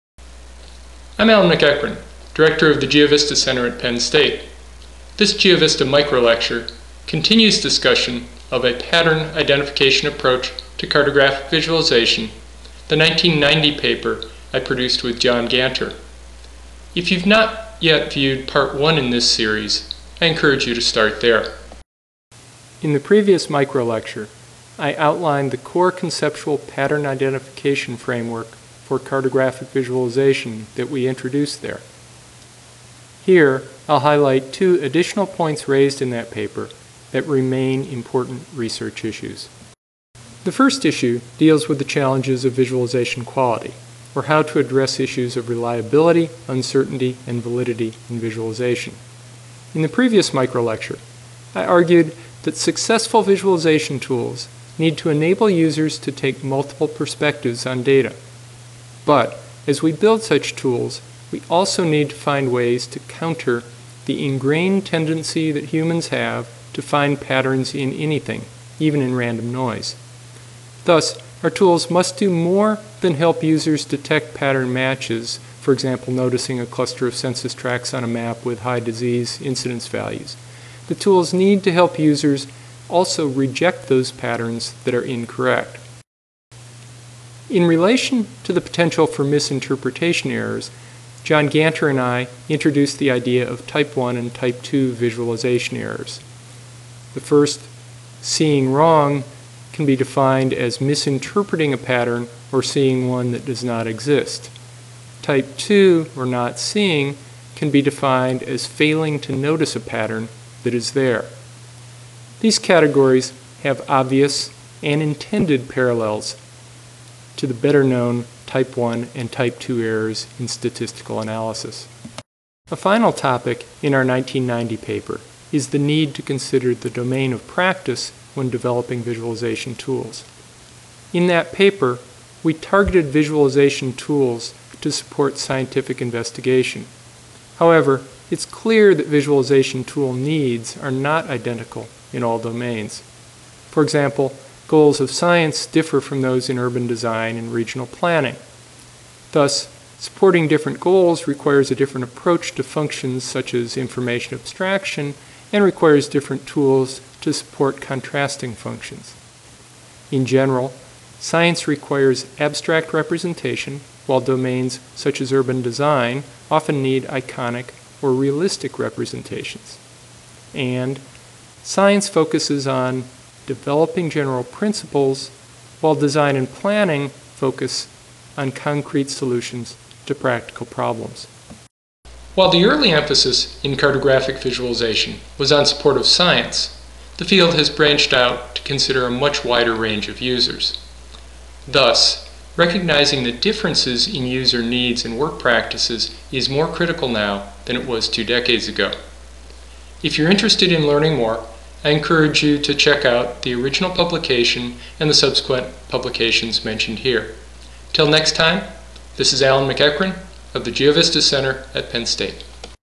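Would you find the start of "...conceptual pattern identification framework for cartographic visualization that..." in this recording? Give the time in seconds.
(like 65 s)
25 s.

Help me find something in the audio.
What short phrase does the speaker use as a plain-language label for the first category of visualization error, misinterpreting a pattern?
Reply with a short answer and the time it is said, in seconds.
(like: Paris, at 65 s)
seeing wrong, at 98 s.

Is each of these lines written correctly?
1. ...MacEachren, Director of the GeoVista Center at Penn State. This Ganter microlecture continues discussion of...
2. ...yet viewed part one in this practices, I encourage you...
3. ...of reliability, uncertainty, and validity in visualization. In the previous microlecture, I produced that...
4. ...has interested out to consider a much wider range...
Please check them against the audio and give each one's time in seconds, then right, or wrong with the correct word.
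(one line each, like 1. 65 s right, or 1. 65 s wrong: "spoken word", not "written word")
1. 1 s wrong: "GeoVista", not "Ganter"
2. 17 s wrong: "series", not "practices"
3. 45 s wrong: "argued", not "produced"
4. 187 s wrong: "branched", not "interested".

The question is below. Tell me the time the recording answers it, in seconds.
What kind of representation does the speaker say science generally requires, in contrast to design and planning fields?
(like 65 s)
162 s.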